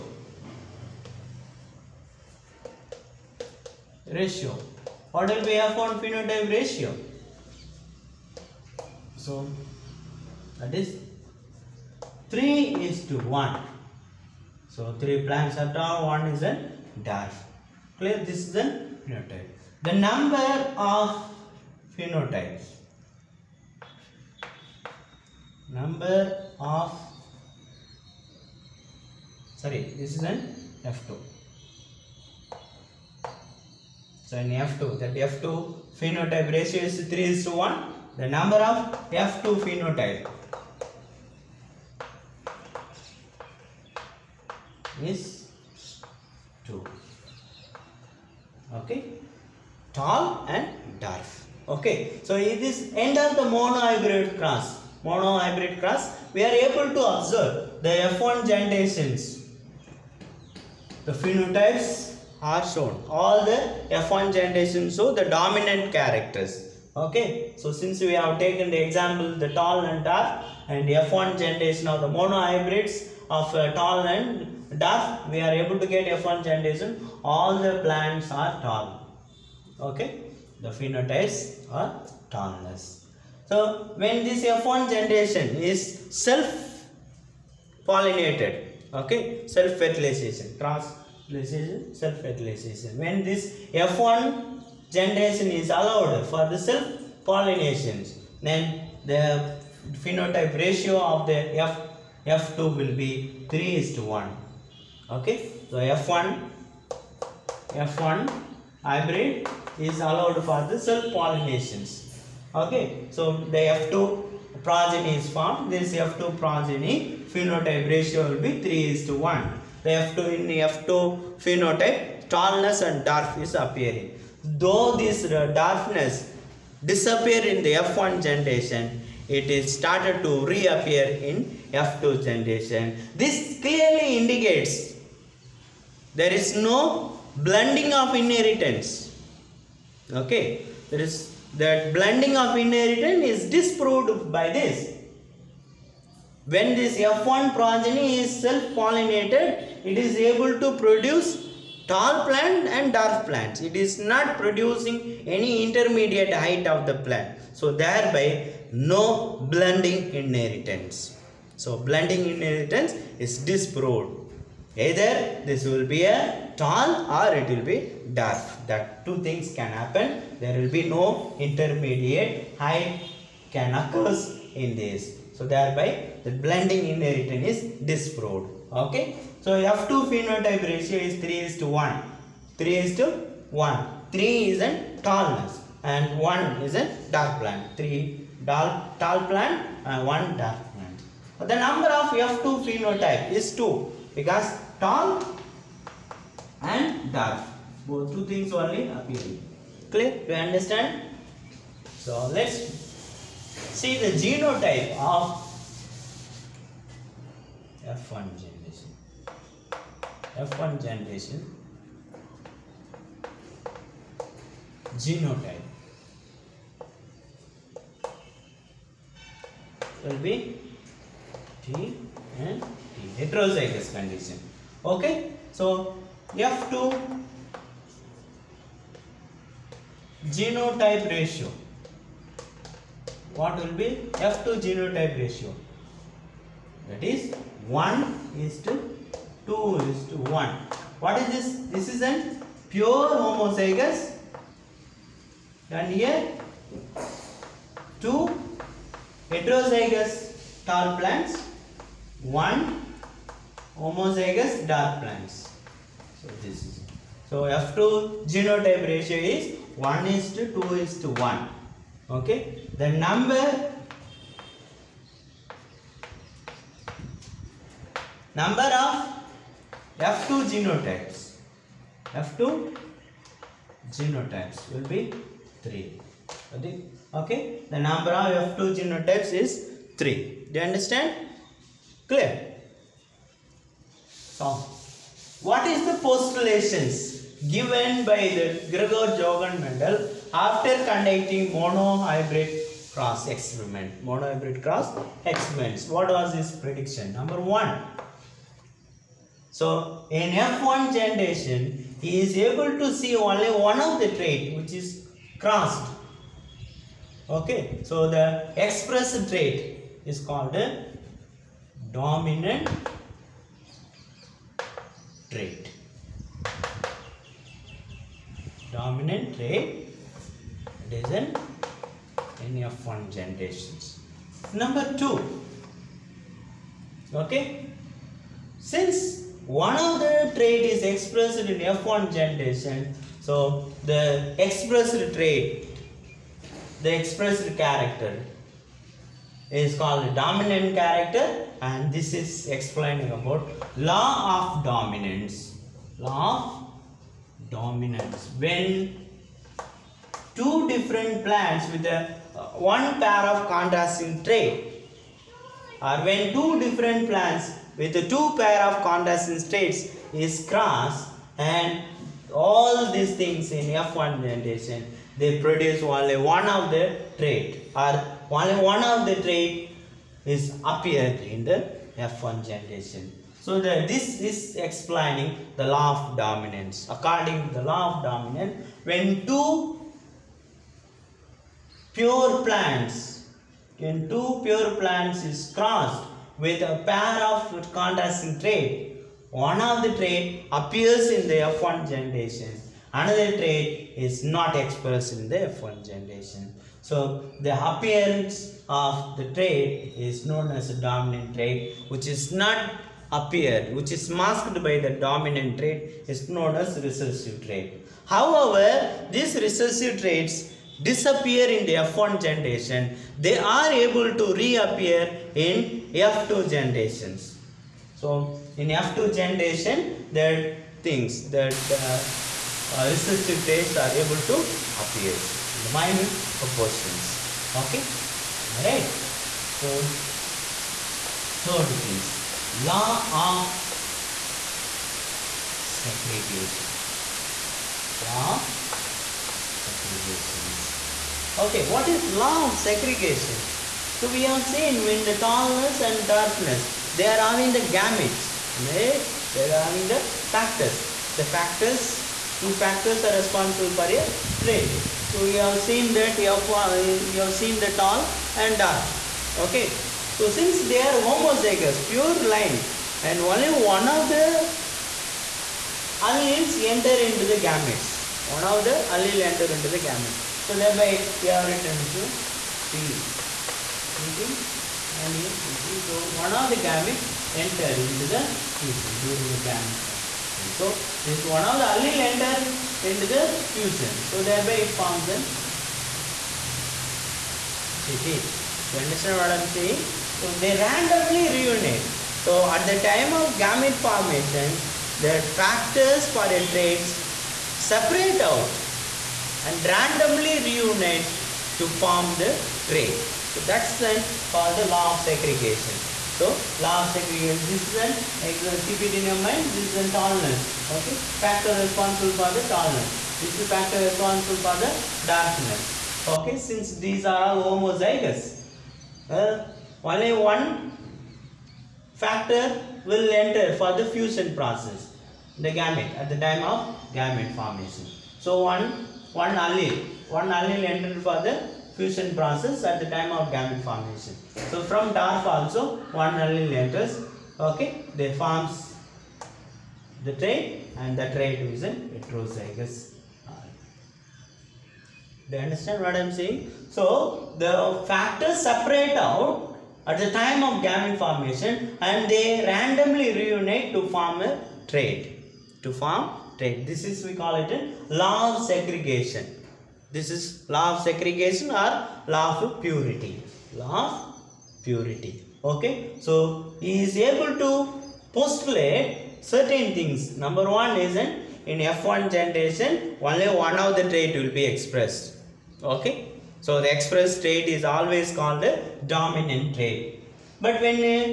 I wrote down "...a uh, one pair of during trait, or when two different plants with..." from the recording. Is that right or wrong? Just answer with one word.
wrong.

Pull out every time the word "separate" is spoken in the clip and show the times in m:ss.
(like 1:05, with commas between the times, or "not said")
8:17, 9:08.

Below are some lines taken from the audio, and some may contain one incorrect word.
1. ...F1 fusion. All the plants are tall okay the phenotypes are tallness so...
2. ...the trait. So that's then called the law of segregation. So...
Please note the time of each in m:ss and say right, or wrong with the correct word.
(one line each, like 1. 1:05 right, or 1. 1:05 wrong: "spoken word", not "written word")
1. 1:16 wrong: "generation", not "fusion"
2. 8:22 right.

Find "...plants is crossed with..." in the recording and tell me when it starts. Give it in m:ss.
6:24.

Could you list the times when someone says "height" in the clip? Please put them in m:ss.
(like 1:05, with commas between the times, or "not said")
2:36, 2:52.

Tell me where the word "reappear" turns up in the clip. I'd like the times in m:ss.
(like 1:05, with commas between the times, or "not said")
2:10, 6:54.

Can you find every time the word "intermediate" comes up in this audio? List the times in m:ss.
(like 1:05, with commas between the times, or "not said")
2:35, 2:51.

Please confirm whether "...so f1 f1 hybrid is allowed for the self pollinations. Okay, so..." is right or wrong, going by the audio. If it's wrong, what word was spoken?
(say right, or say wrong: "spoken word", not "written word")
right.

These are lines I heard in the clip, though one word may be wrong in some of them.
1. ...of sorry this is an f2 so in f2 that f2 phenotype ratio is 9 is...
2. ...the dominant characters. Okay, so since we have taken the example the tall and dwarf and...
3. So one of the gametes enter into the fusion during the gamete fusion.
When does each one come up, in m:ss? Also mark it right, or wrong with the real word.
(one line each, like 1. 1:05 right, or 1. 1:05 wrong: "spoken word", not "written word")
1. 0:26 wrong: "3", not "9"
2. 1:05 right
3. 7:55 right.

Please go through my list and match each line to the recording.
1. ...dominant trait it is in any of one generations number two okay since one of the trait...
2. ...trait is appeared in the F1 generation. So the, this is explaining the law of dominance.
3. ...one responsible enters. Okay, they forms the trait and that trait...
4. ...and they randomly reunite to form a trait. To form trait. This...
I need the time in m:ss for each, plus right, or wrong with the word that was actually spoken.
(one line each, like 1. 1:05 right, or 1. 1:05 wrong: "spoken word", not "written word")
1. 5:18 right
2. 6:09 right
3. 8:56 wrong: "allele", not "responsible"
4. 9:11 right.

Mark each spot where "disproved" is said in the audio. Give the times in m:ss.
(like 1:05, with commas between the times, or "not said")
2:23, 2:43, 2:57.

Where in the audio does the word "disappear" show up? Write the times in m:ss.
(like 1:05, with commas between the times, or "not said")
2:06, 6:50.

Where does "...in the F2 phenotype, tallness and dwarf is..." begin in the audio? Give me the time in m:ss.
2:00.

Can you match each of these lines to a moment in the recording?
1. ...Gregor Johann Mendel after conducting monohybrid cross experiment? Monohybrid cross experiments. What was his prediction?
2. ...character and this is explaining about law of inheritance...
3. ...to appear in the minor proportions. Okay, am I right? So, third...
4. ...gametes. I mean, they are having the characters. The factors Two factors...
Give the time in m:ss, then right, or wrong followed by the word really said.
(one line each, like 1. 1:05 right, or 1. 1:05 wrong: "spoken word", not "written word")
1. 4:48 right
2. 5:40 wrong: "dominance", not "inheritance"
3. 7:04 right
4. 7:27 wrong: "factors", not "characters".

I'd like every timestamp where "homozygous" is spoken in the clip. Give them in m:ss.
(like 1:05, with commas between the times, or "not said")
4:03, 4:13, 7:41, 8:37.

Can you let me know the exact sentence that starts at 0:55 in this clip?
Monohybrid cross, we are able to observe the F1 generations.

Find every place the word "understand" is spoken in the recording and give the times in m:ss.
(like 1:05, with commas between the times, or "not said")
3:20, 4:40, 8:08, 9:05.